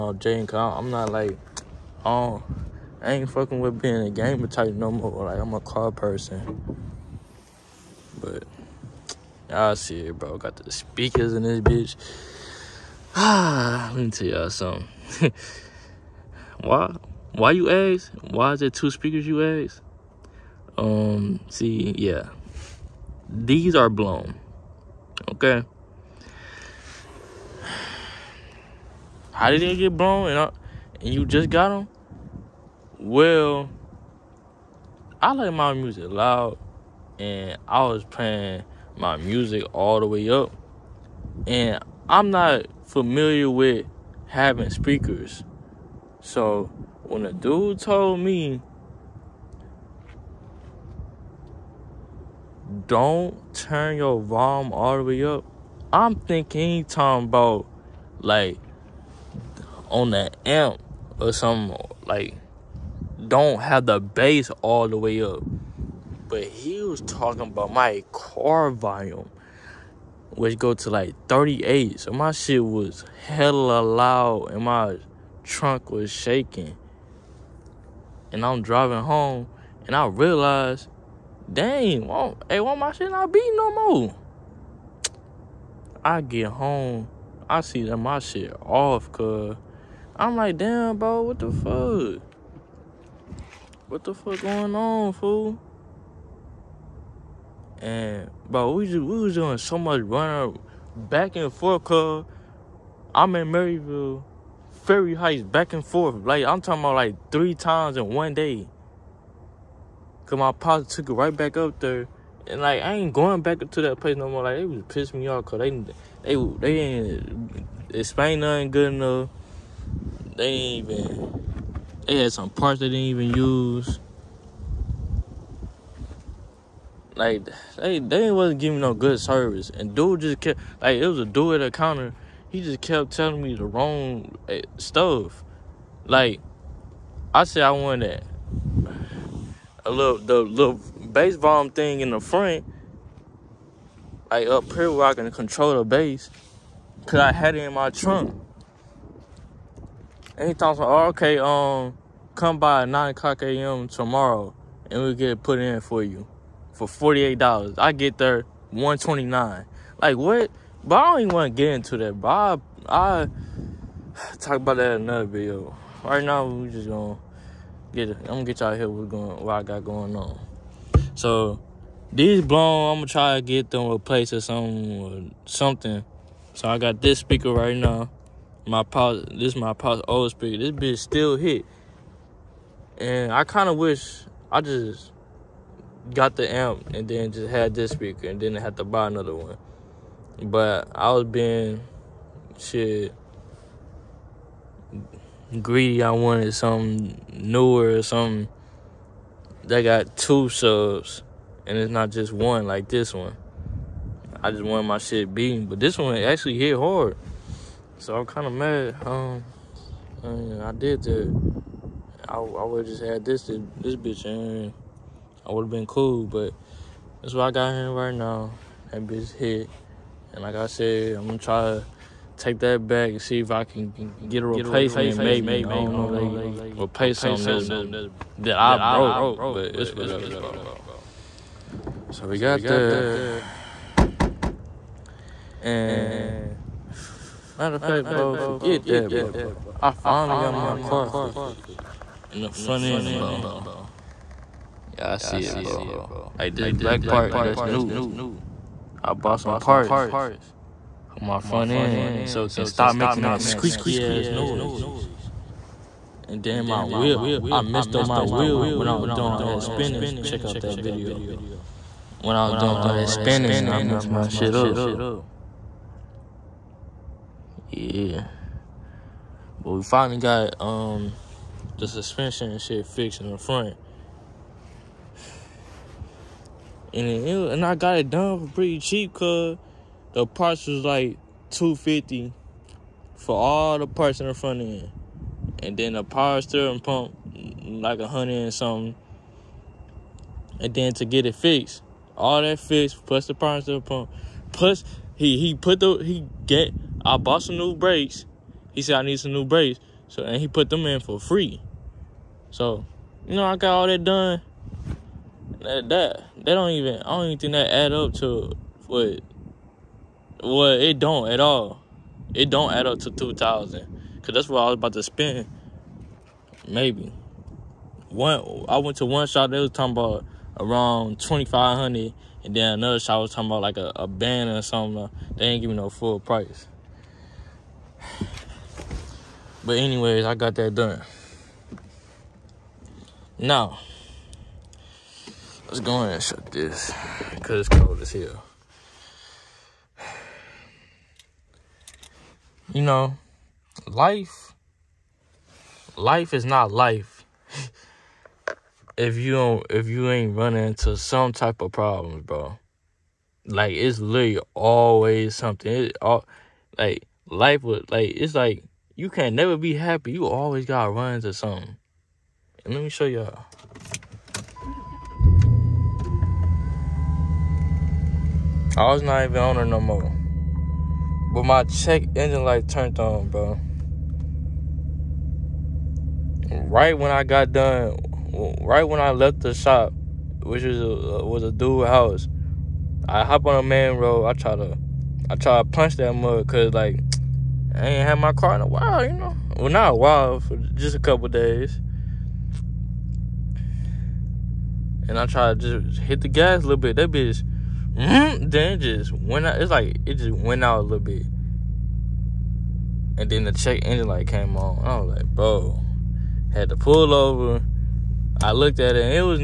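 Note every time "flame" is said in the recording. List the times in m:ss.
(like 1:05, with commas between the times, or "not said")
not said.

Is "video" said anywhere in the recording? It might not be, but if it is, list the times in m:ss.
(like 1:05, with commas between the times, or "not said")
2:45, 4:20.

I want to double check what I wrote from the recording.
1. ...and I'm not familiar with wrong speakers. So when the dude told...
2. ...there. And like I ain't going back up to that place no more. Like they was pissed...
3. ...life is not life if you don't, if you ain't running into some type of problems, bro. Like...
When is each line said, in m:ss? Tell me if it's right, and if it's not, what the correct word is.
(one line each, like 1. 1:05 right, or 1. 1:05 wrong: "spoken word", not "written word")
1. 0:41 wrong: "having", not "wrong"
2. 1:51 right
3. 5:45 right.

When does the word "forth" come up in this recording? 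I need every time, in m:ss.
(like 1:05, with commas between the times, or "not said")
1:41, 1:45.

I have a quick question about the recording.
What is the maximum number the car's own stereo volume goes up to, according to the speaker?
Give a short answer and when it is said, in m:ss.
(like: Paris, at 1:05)
38, at 1:11.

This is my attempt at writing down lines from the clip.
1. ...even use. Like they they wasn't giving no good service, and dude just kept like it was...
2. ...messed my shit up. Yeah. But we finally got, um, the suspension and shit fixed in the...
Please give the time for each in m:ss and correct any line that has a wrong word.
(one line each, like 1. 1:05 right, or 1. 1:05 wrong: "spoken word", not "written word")
1. 2:03 right
2. 4:23 right.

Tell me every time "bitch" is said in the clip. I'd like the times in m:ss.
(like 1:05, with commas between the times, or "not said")
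0:11, 3:00, 3:33, 3:39, 6:37.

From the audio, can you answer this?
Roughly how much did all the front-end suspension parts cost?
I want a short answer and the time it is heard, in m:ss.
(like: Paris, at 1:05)
250, at 4:41.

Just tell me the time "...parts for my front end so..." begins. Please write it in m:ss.
4:09.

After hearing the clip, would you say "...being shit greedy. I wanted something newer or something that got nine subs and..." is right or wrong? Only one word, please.
wrong.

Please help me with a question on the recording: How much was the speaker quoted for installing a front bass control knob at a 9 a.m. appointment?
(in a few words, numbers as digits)
$48.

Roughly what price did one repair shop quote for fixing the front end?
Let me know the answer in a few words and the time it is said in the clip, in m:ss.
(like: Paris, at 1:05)
2500, at 5:21.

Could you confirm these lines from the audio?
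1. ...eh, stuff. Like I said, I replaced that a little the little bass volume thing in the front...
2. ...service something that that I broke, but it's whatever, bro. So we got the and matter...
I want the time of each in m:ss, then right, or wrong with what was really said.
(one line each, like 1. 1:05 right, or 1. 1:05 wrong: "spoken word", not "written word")
1. 2:14 wrong: "wanted", not "replaced"
2. 3:46 wrong: "replace", not "service".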